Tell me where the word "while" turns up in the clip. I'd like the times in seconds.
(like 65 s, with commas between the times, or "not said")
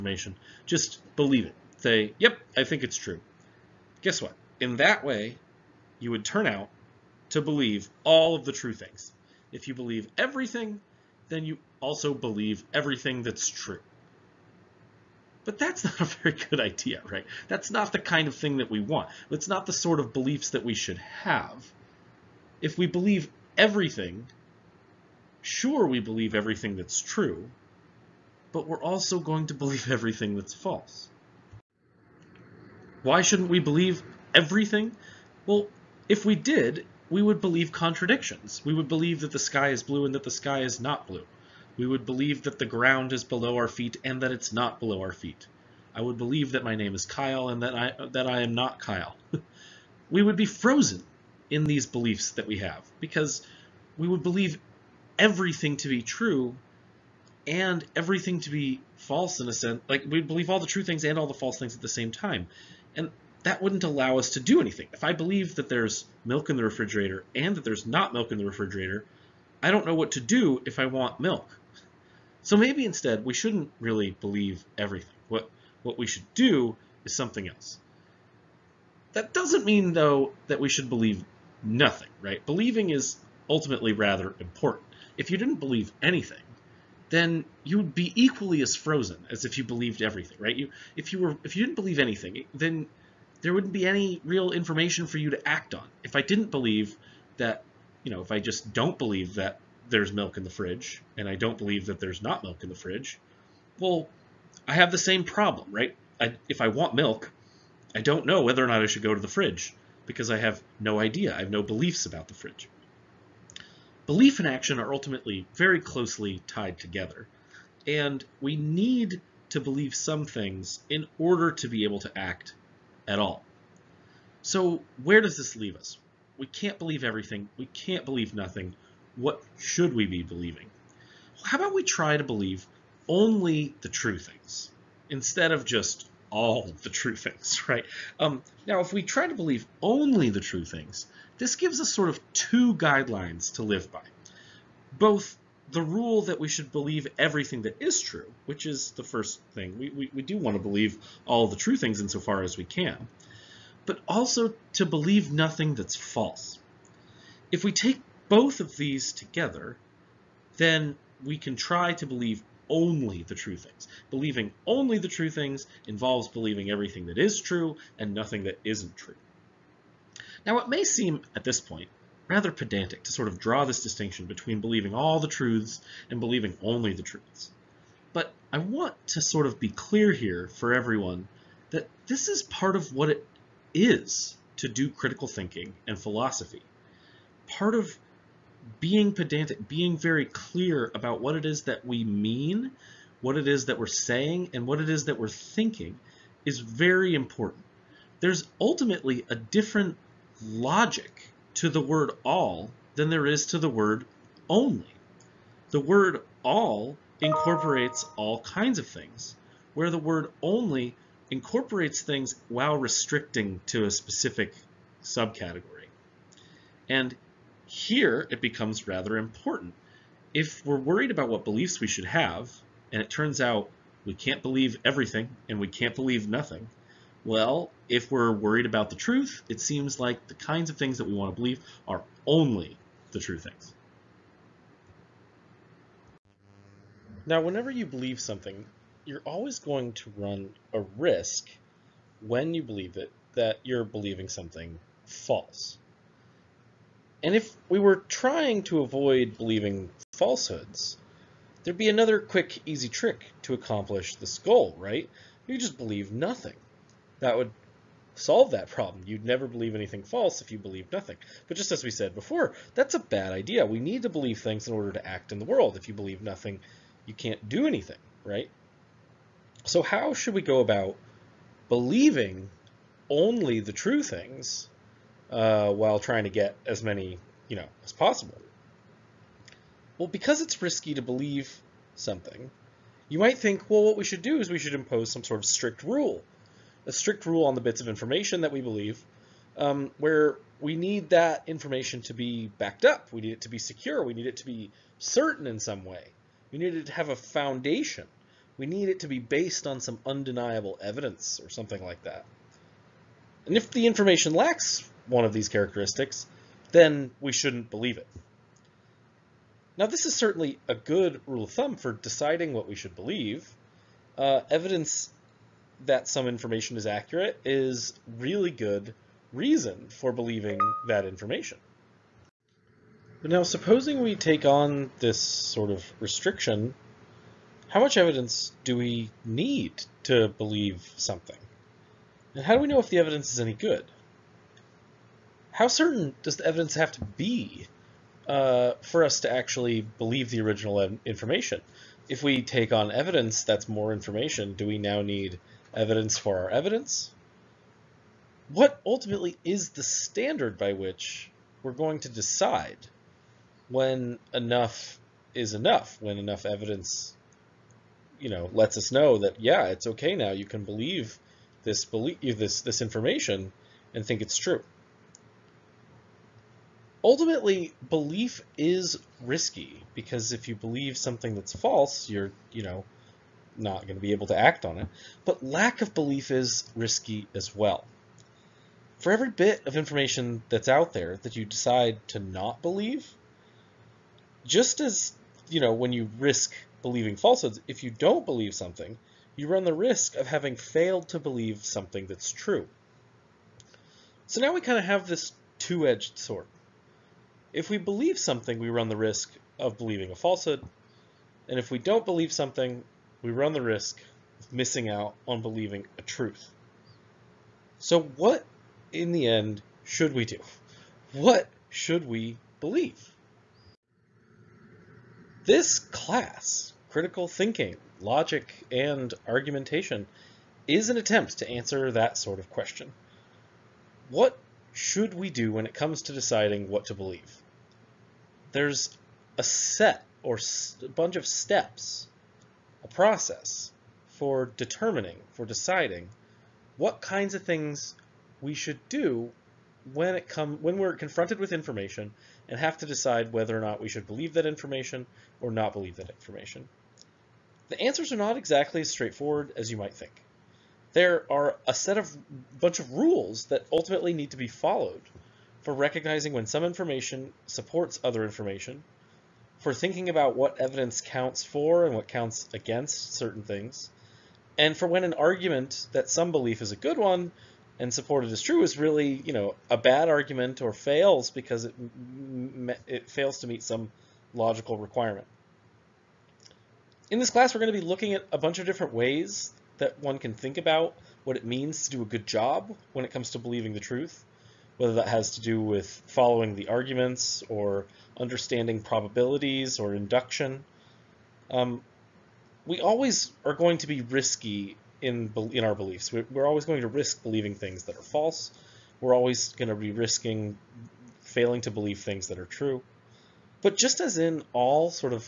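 212 s, 275 s.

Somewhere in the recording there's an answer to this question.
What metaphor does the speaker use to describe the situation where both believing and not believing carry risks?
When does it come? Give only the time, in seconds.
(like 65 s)
395 s.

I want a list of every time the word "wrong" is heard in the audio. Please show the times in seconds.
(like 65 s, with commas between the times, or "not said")
not said.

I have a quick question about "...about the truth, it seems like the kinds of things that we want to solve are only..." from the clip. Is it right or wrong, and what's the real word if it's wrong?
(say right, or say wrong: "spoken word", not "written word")
wrong: "believe", not "solve".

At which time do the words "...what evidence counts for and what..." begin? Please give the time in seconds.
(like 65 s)
460 s.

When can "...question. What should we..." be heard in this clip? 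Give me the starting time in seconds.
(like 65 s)
422 s.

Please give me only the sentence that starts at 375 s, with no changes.
But lack of belief is risky as well.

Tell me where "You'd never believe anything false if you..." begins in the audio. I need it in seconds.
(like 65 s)
259 s.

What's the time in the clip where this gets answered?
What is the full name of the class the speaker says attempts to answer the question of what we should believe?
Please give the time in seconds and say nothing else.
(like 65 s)
416 s.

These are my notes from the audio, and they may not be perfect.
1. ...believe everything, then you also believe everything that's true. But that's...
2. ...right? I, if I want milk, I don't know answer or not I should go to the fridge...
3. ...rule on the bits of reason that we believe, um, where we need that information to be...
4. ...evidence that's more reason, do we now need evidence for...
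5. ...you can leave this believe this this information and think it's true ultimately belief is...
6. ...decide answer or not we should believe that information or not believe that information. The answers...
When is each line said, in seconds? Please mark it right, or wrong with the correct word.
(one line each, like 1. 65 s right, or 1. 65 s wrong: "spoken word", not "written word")
1. 9 s right
2. 105 s wrong: "whether", not "answer"
3. 287 s wrong: "information", not "reason"
4. 342 s wrong: "information", not "reason"
5. 360 s wrong: "believe", not "leave"
6. 442 s wrong: "whether", not "answer".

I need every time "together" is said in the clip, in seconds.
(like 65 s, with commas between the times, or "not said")
116 s, 159 s.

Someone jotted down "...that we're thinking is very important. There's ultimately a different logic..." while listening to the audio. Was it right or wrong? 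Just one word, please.
right.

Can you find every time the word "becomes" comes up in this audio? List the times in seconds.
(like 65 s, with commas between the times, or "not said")
218 s.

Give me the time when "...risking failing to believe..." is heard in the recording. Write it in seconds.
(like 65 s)
499 s.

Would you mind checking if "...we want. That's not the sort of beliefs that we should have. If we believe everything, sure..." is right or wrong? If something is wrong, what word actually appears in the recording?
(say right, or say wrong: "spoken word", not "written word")
right.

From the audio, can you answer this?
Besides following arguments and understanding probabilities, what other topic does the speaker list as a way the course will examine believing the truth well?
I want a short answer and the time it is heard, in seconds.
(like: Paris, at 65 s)
induction, at 489 s.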